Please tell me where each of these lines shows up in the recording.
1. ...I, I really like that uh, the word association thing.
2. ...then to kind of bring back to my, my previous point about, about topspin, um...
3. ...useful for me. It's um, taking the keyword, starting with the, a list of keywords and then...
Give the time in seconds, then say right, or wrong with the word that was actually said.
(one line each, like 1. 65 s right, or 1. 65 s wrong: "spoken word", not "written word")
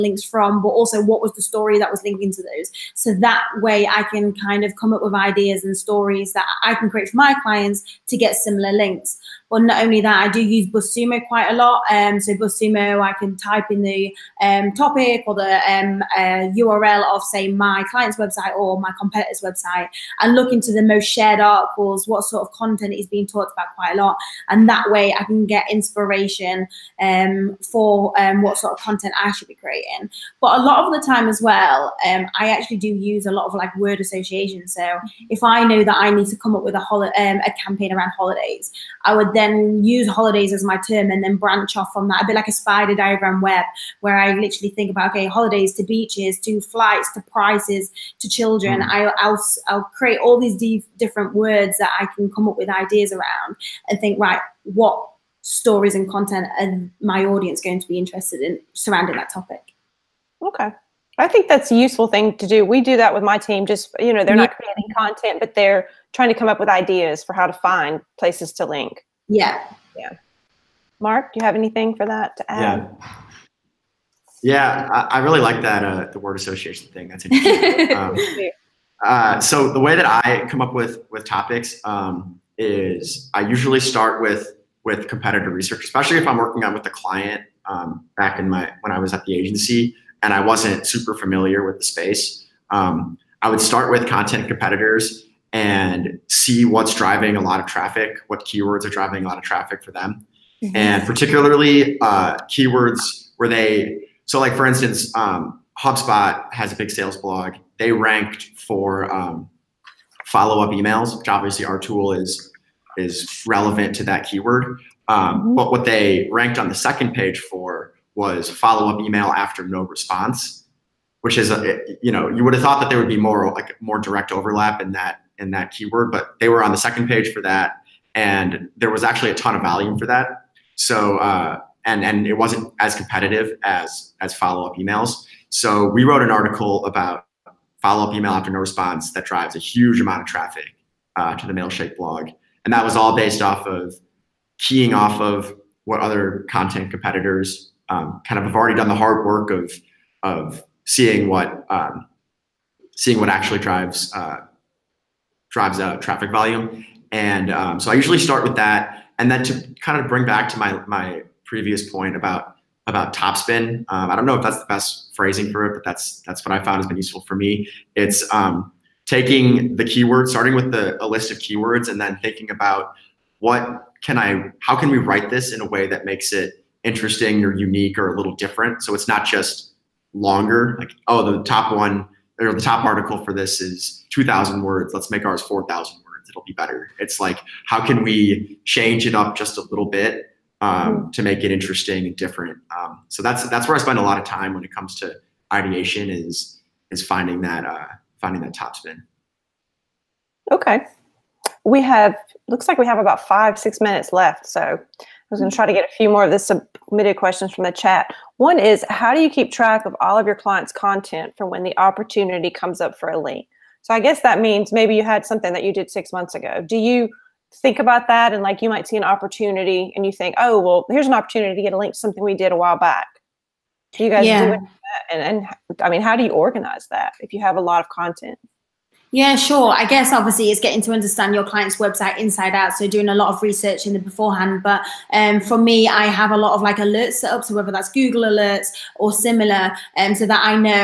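1. 74 s right
2. 159 s right
3. 166 s right.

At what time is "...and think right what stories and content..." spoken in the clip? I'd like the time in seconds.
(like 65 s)
53 s.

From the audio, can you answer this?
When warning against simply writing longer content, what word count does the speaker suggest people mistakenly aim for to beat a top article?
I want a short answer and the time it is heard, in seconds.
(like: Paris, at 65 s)
4000 words, at 185 s.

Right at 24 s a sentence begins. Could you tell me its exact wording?
And that way I can get inspiration um, for um, what sort of content I should be creating.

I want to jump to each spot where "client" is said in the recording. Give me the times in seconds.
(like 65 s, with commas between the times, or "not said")
7 s, 17 s, 86 s, 210 s, 231 s.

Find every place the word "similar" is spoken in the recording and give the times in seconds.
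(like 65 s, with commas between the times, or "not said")
8 s, 239 s.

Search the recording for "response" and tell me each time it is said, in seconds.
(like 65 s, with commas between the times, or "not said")
119 s, 138 s.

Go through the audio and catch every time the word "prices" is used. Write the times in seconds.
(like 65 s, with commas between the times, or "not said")
47 s.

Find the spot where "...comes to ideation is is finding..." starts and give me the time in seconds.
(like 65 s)
194 s.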